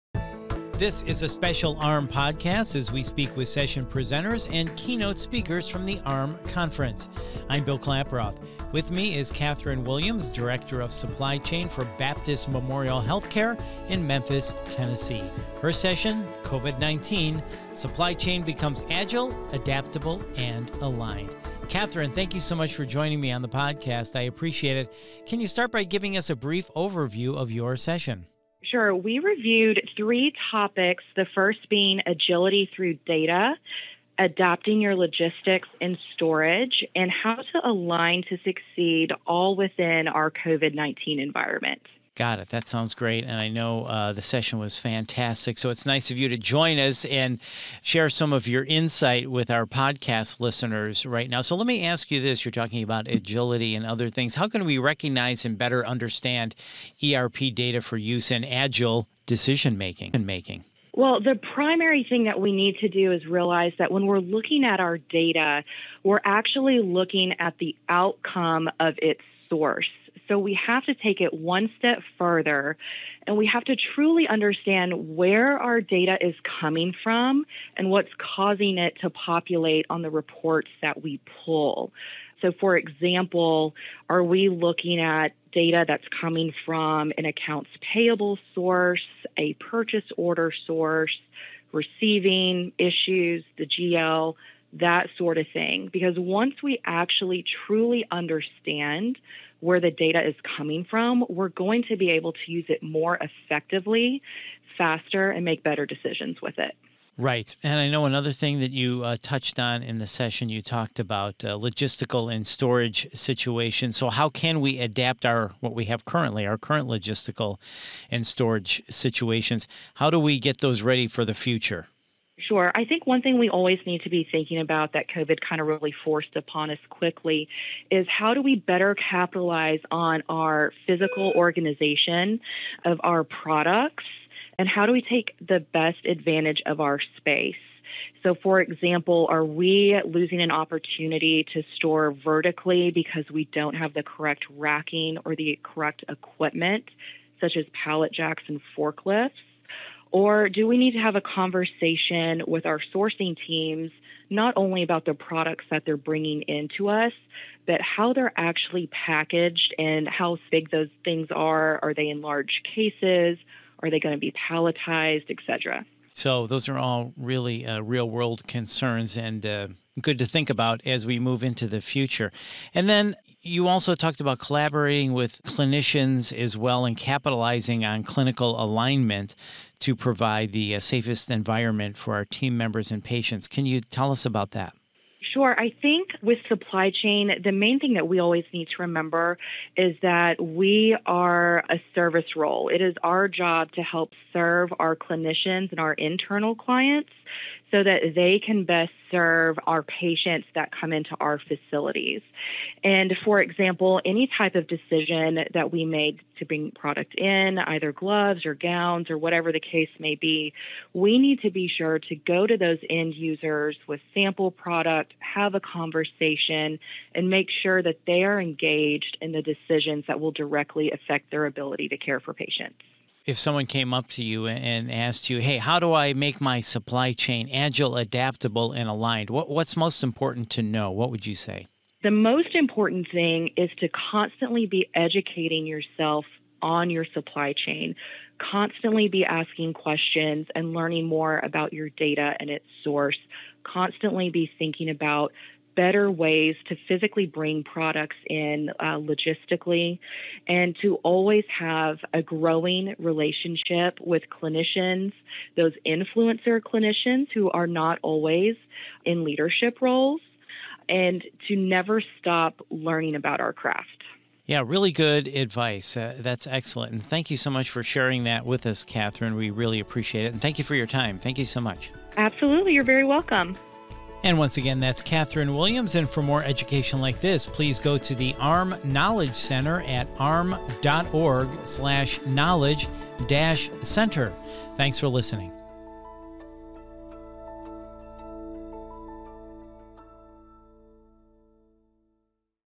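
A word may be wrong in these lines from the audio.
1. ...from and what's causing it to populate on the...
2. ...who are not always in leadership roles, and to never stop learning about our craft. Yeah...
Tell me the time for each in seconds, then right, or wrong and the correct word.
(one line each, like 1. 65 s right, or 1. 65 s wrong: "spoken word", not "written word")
1. 77 s right
2. 257 s right.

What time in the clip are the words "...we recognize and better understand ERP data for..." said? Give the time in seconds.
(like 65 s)
54 s.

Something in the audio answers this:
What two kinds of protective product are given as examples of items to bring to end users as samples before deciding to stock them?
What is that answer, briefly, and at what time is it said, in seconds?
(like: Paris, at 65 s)
gloves or gowns, at 207 s.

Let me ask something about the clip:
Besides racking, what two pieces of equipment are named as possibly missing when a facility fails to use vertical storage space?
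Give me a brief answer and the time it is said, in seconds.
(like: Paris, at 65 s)
pallet jacks and forklifts, at 147 s.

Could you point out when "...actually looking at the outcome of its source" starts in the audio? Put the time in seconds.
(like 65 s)
66 s.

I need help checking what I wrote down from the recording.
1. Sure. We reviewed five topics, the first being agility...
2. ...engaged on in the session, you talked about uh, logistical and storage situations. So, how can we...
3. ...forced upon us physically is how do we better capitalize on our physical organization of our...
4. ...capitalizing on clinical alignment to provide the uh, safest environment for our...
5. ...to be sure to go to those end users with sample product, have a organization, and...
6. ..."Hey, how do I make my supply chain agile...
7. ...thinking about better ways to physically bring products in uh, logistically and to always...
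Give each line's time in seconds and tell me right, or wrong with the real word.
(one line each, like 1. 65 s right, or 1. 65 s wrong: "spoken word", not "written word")
1. 28 s wrong: "three", not "five"
2. 109 s wrong: "touched", not "engaged"
3. 126 s wrong: "quickly", not "physically"
4. 176 s right
5. 211 s wrong: "conversation", not "organization"
6. 225 s right
7. 244 s right.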